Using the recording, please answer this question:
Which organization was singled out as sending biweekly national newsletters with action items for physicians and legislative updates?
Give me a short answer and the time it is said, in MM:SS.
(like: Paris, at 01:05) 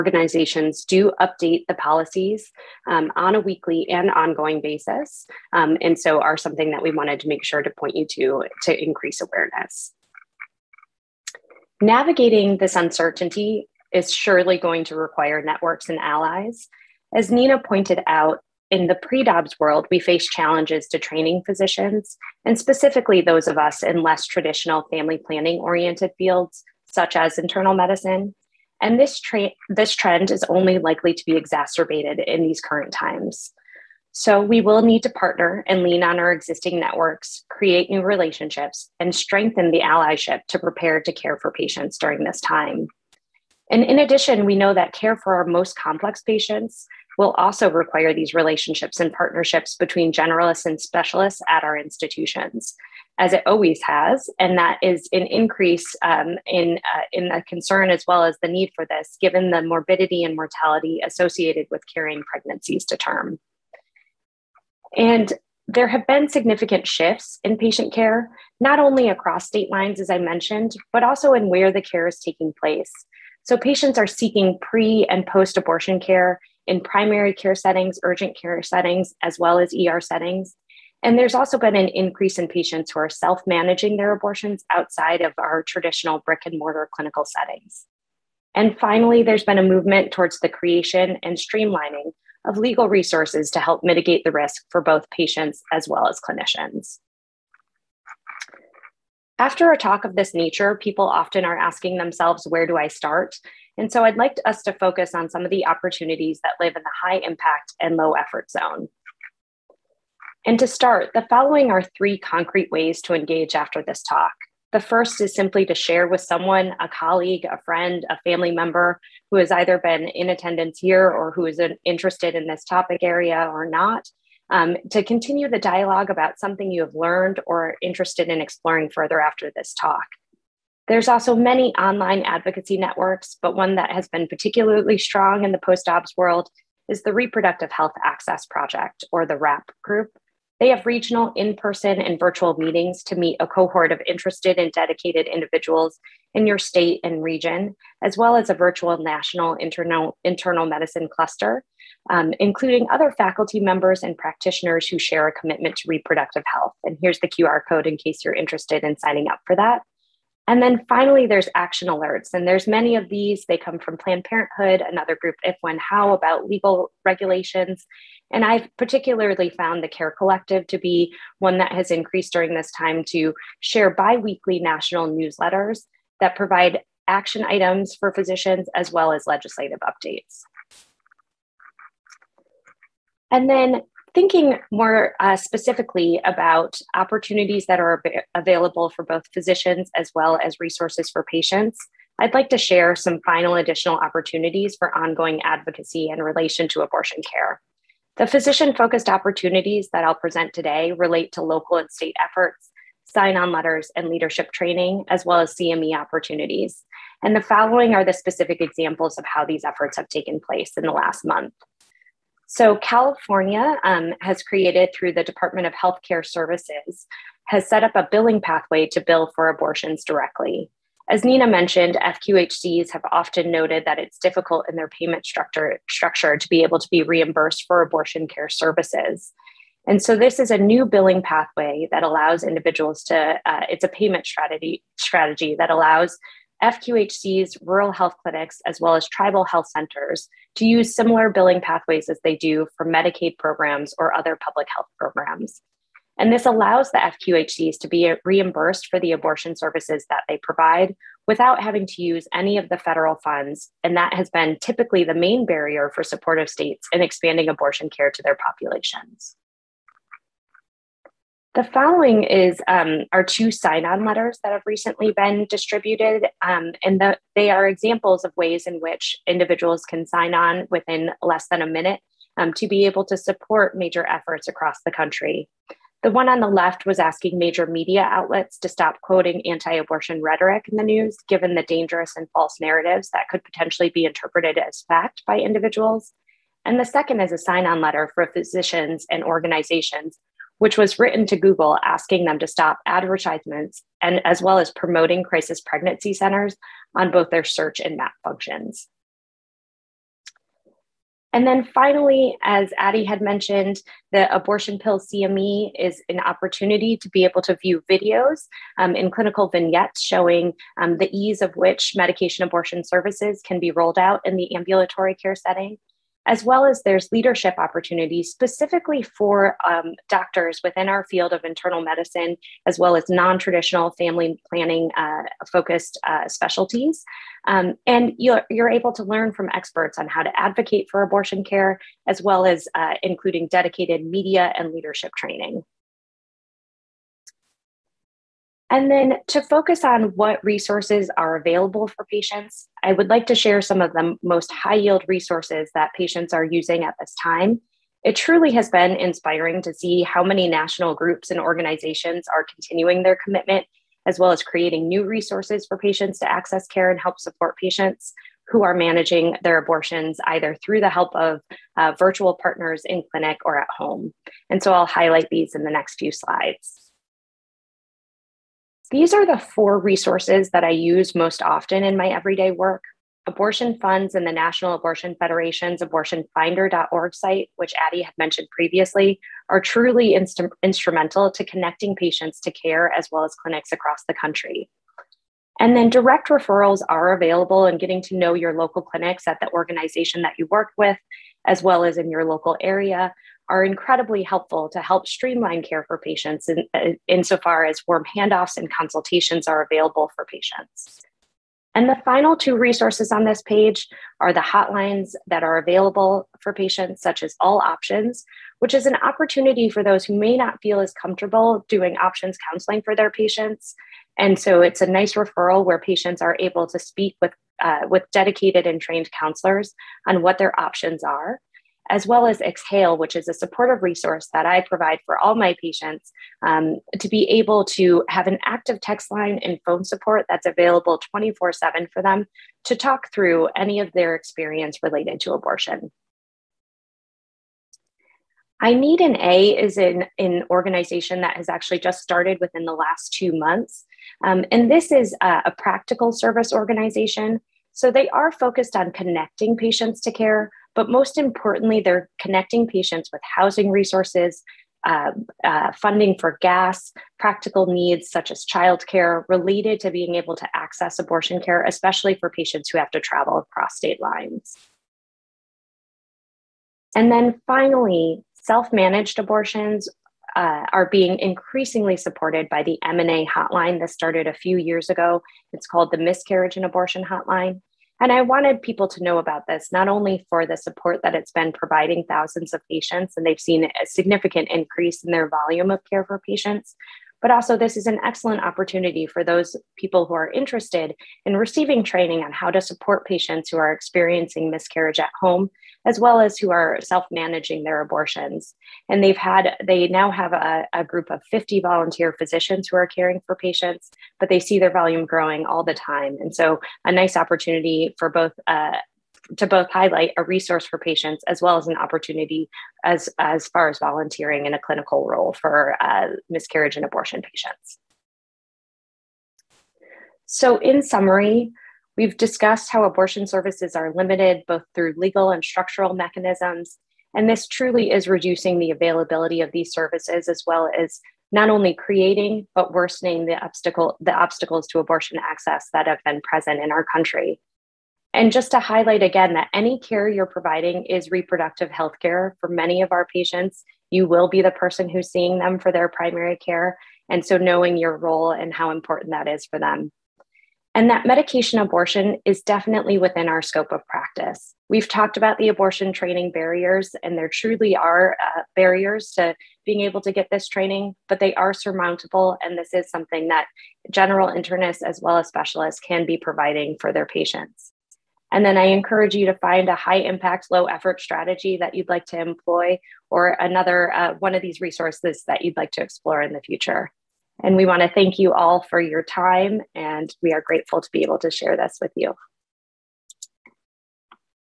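Care Collective, at 02:49.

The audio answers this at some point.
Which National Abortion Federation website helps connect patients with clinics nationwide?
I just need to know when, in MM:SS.
06:15.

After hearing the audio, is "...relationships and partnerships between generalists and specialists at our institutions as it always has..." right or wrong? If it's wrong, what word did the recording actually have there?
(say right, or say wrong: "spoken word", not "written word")
right.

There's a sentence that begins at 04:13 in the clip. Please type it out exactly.
And that has been typically the main barrier for supportive states in expanding abortion care to their populations.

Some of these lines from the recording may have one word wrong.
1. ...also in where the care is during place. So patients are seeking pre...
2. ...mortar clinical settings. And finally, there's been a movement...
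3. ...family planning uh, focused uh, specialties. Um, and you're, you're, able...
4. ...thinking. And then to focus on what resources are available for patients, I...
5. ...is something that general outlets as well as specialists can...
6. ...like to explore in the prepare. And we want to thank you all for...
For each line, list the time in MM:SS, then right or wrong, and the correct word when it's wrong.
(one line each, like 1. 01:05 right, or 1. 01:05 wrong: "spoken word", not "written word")
1. 01:11 wrong: "taking", not "during"
2. 01:26 right
3. 05:23 right
4. 05:35 wrong: "training", not "thinking"
5. 09:22 wrong: "internists", not "outlets"
6. 09:35 wrong: "future", not "prepare".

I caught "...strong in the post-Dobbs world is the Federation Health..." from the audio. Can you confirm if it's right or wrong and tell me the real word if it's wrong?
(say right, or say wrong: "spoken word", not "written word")
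wrong: "Reproductive", not "Federation".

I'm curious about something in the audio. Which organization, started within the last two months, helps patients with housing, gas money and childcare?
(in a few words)
I Need an A.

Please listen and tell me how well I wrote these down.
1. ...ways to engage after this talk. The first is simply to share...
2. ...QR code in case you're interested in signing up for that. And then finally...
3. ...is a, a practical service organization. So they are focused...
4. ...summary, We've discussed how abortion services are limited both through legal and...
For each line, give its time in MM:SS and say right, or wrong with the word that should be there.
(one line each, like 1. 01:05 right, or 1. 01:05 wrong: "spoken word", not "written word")
1. 01:52 right
2. 02:37 right
3. 07:24 right
4. 08:40 right.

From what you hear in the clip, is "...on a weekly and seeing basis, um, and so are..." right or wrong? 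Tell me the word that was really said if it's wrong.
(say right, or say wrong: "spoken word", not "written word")
wrong: "ongoing", not "seeing".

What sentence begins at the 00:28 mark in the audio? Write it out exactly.
And this, tra- this trend is only likely to be exacerbated in these current times.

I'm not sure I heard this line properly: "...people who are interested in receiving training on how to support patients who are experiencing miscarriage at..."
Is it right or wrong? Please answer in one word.
right.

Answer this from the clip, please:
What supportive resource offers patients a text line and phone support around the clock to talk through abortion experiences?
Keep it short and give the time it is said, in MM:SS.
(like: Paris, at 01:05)
Exhale, at 07:02.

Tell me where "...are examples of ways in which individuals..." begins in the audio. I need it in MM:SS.
04:27.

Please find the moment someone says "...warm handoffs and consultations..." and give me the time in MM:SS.
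06:37.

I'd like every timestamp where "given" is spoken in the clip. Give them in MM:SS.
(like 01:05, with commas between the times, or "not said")
00:59, 04:41.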